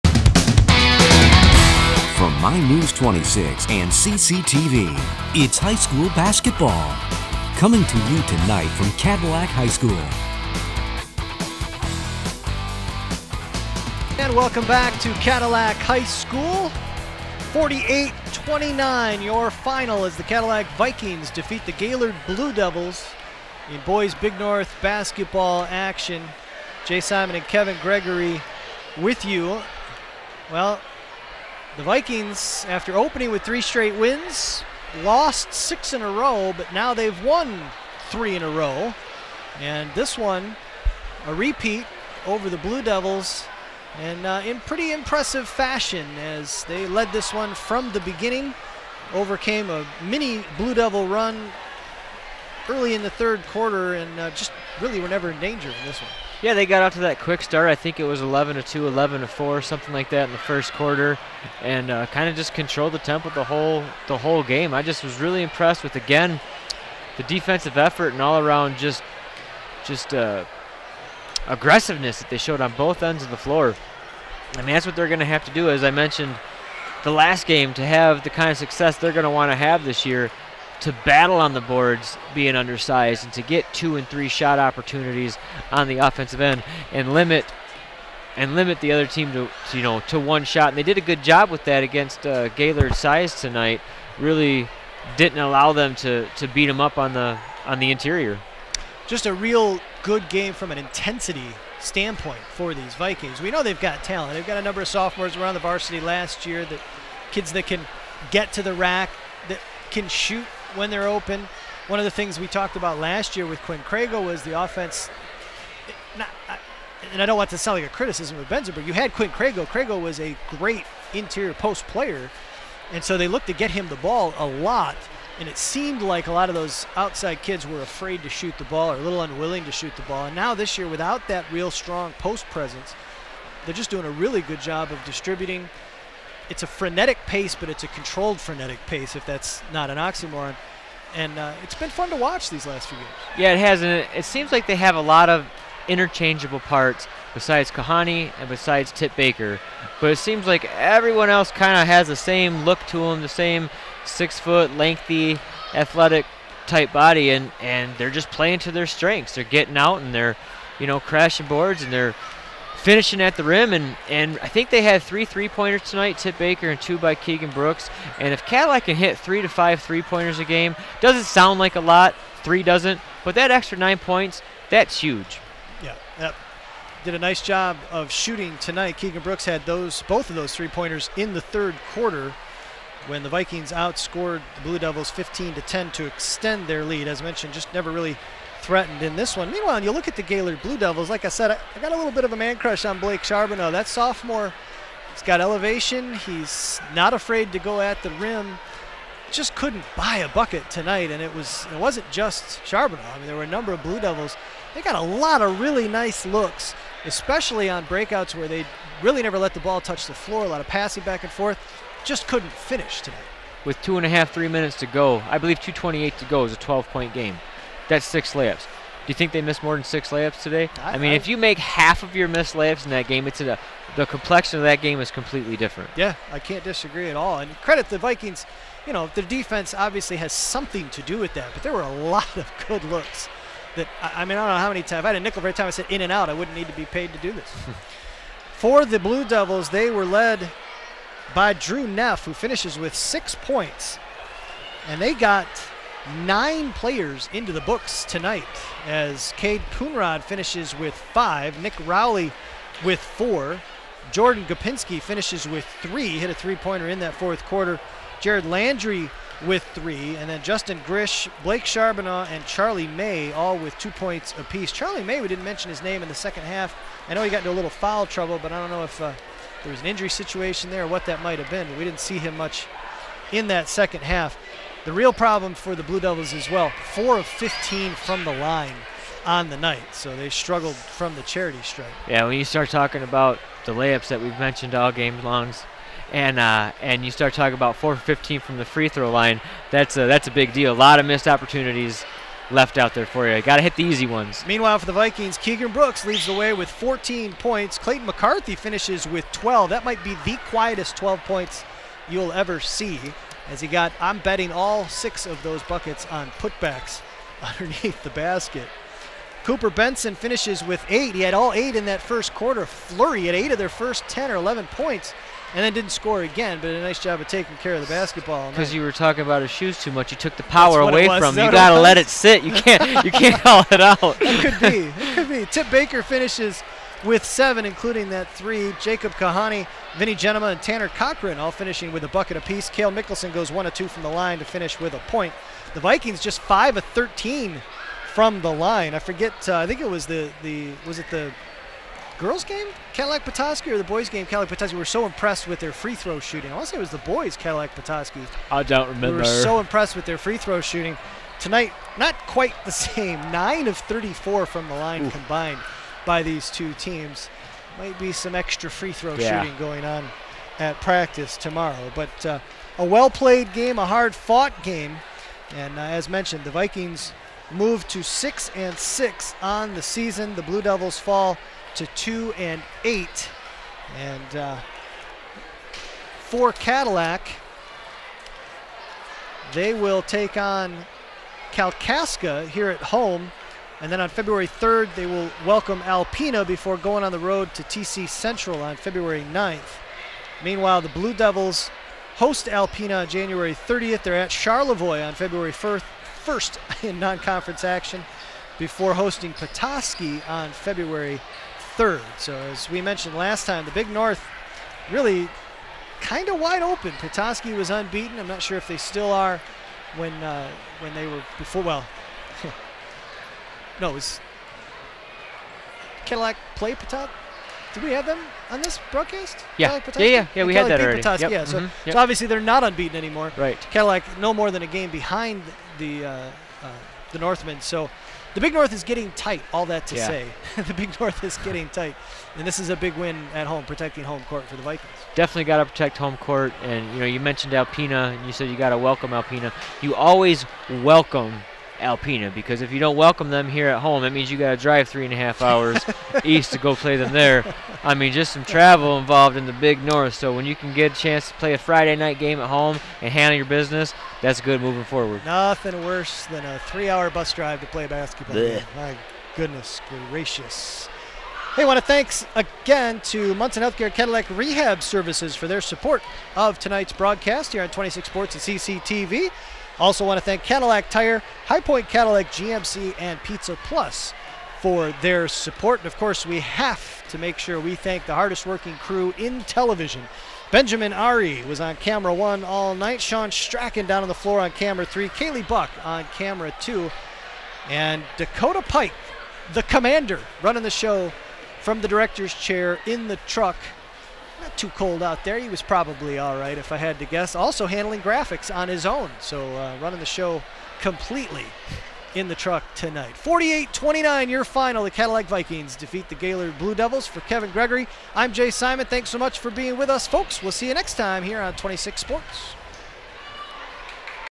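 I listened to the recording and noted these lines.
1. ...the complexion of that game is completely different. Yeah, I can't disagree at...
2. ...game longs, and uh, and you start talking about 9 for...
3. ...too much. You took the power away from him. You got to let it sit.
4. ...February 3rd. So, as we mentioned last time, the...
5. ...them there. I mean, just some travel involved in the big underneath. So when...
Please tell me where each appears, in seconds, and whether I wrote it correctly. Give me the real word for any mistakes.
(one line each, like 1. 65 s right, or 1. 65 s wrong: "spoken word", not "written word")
1. 223 s right
2. 284 s wrong: "4", not "9"
3. 319 s right
4. 400 s right
5. 446 s wrong: "north", not "underneath".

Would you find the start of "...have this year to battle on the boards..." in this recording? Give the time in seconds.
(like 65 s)
79 s.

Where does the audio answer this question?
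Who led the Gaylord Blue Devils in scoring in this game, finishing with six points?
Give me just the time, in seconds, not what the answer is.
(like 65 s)
241 s.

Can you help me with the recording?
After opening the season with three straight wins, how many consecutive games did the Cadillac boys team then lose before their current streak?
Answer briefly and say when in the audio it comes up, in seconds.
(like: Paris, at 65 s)
6, at 35 s.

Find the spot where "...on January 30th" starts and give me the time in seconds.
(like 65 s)
393 s.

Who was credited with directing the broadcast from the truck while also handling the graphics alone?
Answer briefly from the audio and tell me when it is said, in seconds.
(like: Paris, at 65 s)
Dakota Pike, at 488 s.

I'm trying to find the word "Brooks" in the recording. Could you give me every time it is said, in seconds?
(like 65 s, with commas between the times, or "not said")
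167 s, 179 s, 295 s.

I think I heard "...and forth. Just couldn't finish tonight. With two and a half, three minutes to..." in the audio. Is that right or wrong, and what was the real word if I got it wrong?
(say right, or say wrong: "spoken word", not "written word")
right.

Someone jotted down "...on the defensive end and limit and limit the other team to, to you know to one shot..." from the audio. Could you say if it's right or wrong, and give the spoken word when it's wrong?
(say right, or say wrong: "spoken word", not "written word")
wrong: "offensive", not "defensive".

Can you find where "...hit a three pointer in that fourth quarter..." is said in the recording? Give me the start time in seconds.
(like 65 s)
256 s.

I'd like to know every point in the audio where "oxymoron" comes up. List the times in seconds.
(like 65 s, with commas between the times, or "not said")
139 s.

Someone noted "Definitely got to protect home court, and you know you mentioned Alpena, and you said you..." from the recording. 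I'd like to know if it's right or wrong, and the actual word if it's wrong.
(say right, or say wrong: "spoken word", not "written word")
right.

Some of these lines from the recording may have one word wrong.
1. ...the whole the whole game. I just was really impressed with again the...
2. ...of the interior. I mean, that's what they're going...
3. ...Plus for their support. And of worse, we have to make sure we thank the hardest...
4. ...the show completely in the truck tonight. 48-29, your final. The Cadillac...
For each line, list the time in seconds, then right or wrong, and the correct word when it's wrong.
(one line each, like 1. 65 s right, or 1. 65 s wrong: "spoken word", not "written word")
1. 63 s right
2. 73 s wrong: "floor", not "interior"
3. 473 s wrong: "course", not "worse"
4. 499 s right.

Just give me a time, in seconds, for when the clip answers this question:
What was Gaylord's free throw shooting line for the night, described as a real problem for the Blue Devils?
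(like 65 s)
276 s.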